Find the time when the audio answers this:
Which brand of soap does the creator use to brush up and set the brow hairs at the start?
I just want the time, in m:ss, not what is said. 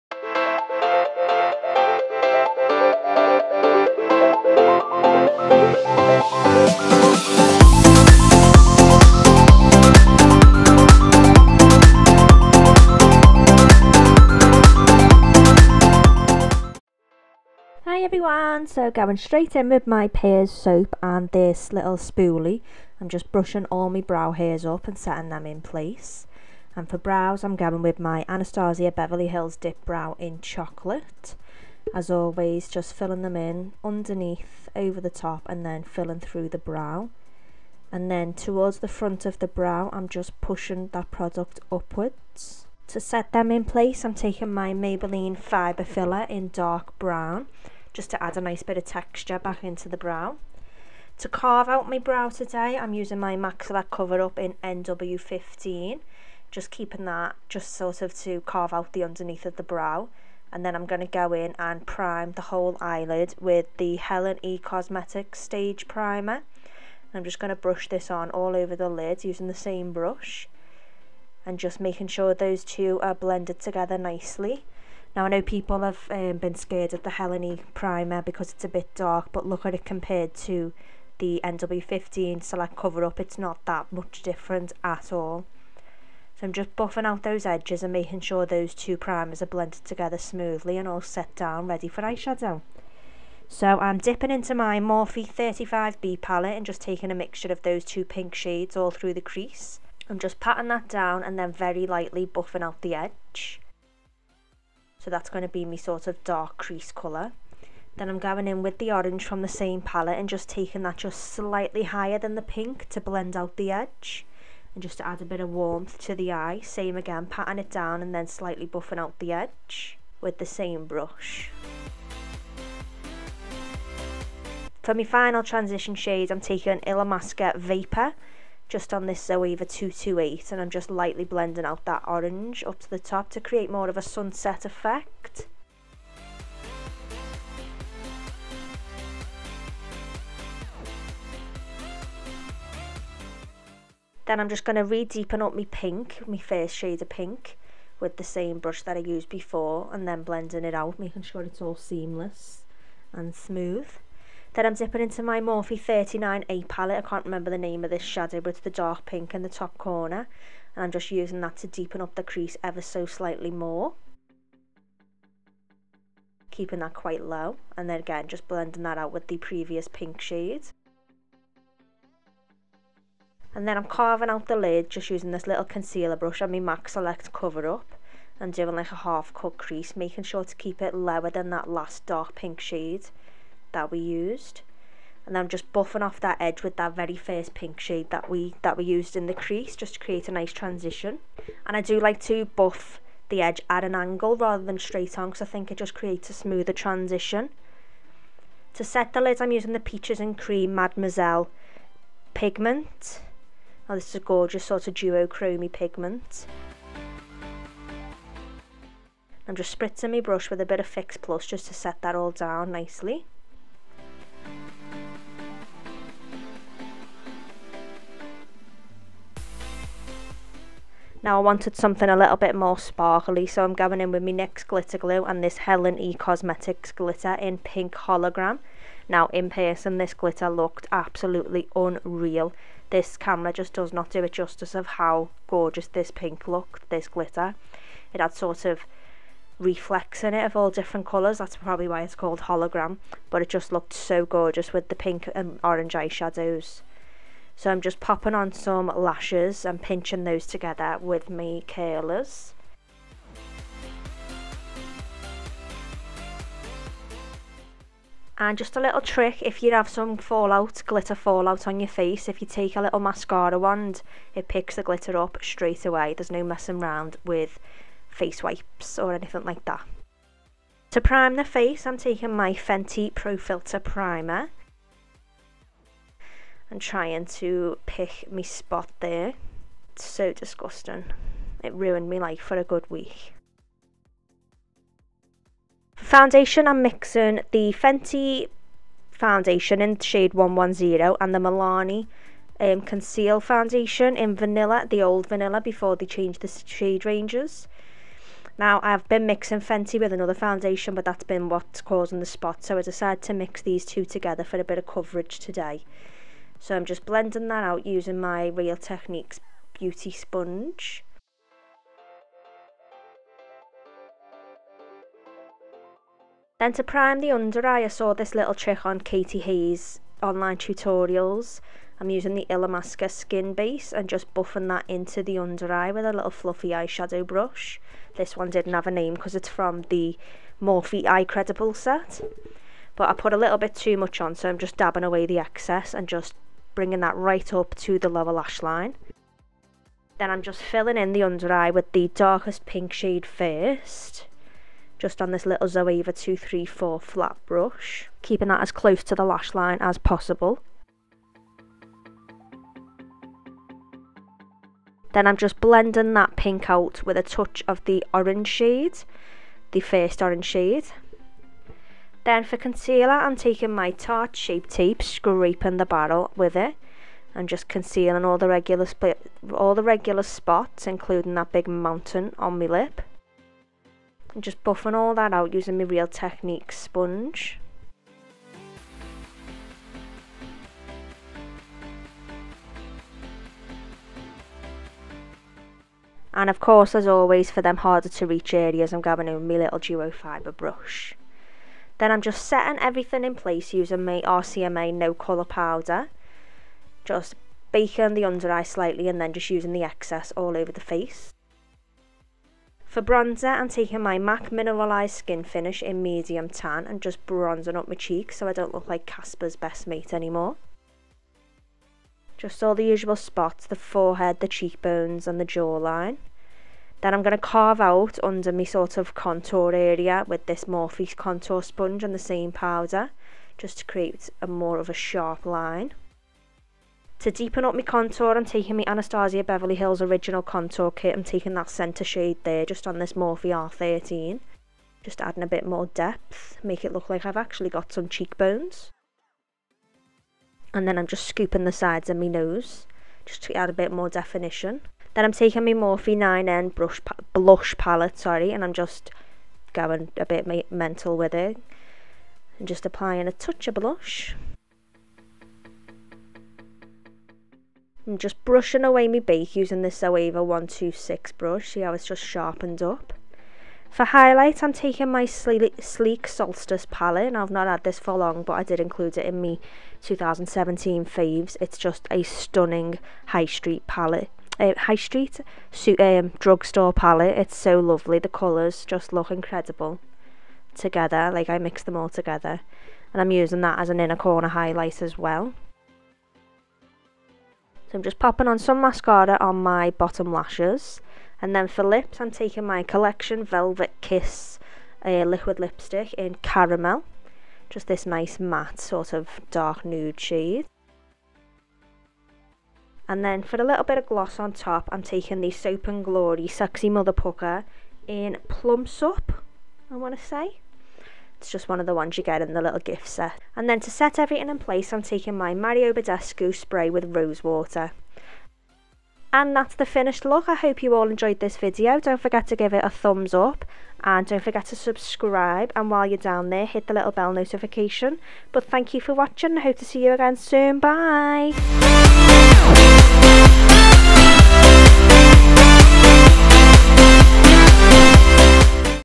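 0:20.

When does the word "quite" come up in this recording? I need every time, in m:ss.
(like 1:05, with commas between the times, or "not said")
2:46.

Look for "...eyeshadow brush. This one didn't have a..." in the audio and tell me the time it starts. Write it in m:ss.
5:26.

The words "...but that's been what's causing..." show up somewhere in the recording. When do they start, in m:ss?
5:00.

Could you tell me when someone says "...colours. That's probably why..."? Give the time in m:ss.
4:01.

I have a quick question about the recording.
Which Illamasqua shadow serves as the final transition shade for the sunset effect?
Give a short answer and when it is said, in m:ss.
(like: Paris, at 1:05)
Vapour, at 2:07.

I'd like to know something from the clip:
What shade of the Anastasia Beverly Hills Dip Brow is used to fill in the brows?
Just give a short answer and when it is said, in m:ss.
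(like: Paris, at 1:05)
Chocolate, at 0:30.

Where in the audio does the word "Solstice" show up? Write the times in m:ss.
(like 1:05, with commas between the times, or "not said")
7:46.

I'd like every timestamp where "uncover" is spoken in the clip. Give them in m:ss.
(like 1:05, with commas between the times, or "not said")
not said.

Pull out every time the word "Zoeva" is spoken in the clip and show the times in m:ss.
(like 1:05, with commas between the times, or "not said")
2:09, 5:45, 7:40.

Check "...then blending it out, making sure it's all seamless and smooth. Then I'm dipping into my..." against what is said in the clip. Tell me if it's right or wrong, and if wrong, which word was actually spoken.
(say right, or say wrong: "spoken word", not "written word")
right.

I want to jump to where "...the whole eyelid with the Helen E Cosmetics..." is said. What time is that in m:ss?
1:02.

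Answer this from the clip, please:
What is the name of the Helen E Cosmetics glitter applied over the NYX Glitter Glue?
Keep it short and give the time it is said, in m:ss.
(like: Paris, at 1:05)
pink hologram, at 3:47.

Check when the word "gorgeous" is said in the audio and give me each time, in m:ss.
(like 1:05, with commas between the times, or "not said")
3:24, 3:55, 4:04.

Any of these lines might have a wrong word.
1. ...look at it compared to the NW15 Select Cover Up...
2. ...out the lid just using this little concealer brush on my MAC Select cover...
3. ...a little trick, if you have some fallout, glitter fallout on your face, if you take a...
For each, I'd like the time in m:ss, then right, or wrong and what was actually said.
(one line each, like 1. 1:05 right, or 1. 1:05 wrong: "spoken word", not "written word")
1. 1:19 right
2. 2:54 right
3. 4:18 right.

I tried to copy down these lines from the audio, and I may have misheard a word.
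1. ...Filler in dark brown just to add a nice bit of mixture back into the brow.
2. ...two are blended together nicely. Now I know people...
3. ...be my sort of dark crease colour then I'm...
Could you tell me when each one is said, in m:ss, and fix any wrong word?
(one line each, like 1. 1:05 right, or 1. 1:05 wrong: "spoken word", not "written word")
1. 0:45 wrong: "texture", not "mixture"
2. 1:12 right
3. 1:45 right.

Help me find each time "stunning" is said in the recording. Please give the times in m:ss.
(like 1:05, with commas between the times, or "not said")
7:52.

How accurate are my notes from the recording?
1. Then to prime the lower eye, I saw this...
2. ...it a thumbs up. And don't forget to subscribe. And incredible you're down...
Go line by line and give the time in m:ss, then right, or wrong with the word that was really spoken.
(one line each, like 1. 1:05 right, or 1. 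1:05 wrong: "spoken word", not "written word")
1. 5:16 wrong: "under", not "lower"
2. 8:42 wrong: "while", not "incredible".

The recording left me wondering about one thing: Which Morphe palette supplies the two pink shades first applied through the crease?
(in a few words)
35B.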